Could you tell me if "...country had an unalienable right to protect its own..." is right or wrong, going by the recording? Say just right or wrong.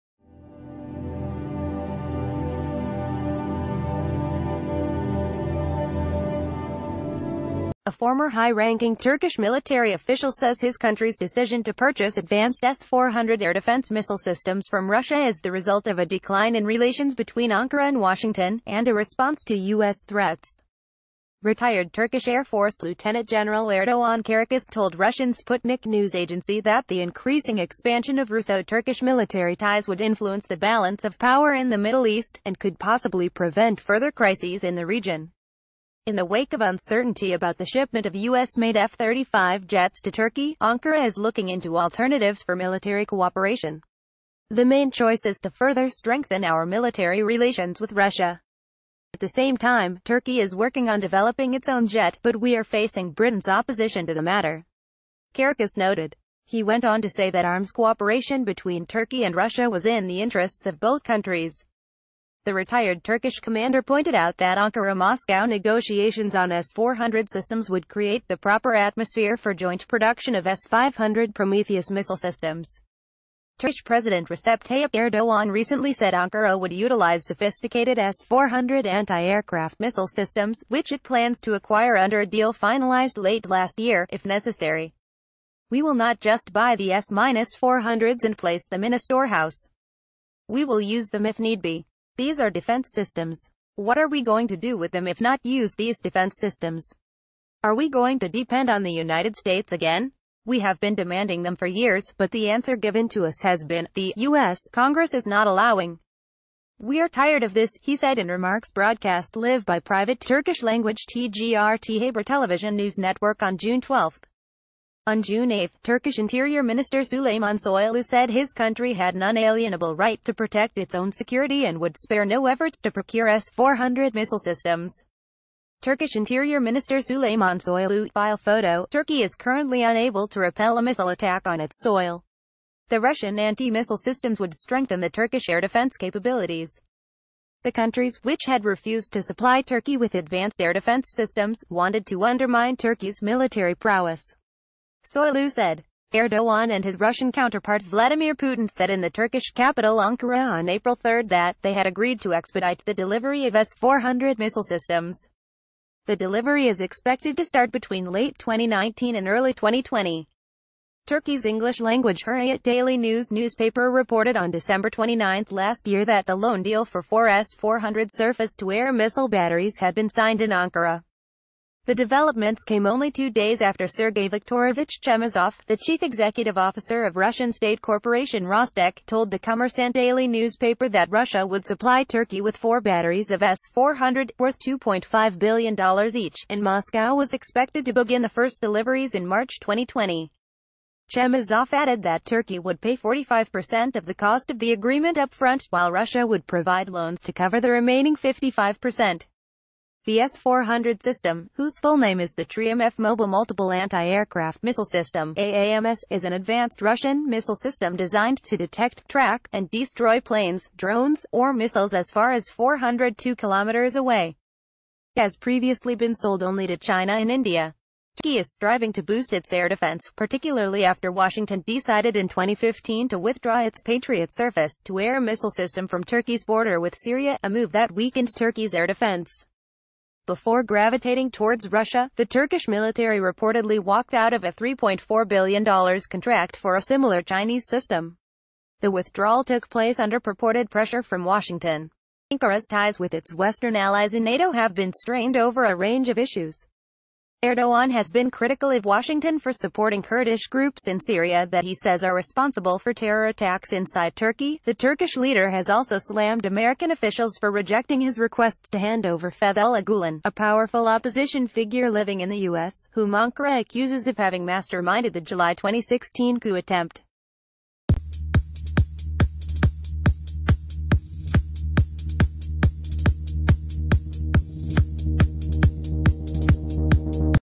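right.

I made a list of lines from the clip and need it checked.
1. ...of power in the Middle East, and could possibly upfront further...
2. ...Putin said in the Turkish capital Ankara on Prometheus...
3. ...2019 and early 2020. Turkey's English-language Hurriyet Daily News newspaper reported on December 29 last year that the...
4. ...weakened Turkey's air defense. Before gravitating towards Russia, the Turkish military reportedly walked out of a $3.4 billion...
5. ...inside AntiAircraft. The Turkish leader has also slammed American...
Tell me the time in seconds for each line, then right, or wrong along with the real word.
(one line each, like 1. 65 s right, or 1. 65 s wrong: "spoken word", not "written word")
1. 31 s wrong: "prevent", not "upfront"
2. 148 s wrong: "April", not "Prometheus"
3. 158 s right
4. 227 s right
5. 253 s wrong: "Turkey", not "AntiAircraft".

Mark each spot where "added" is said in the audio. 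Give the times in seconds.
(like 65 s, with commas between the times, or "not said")
191 s.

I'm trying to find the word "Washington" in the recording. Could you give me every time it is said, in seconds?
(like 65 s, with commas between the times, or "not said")
17 s, 221 s, 241 s, 248 s.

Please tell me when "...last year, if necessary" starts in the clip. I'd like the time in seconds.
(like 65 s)
83 s.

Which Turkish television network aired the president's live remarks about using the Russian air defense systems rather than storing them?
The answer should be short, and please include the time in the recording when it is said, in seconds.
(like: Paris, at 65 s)
TGRT Haber, at 111 s.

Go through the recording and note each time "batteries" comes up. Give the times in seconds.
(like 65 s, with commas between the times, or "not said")
169 s, 182 s.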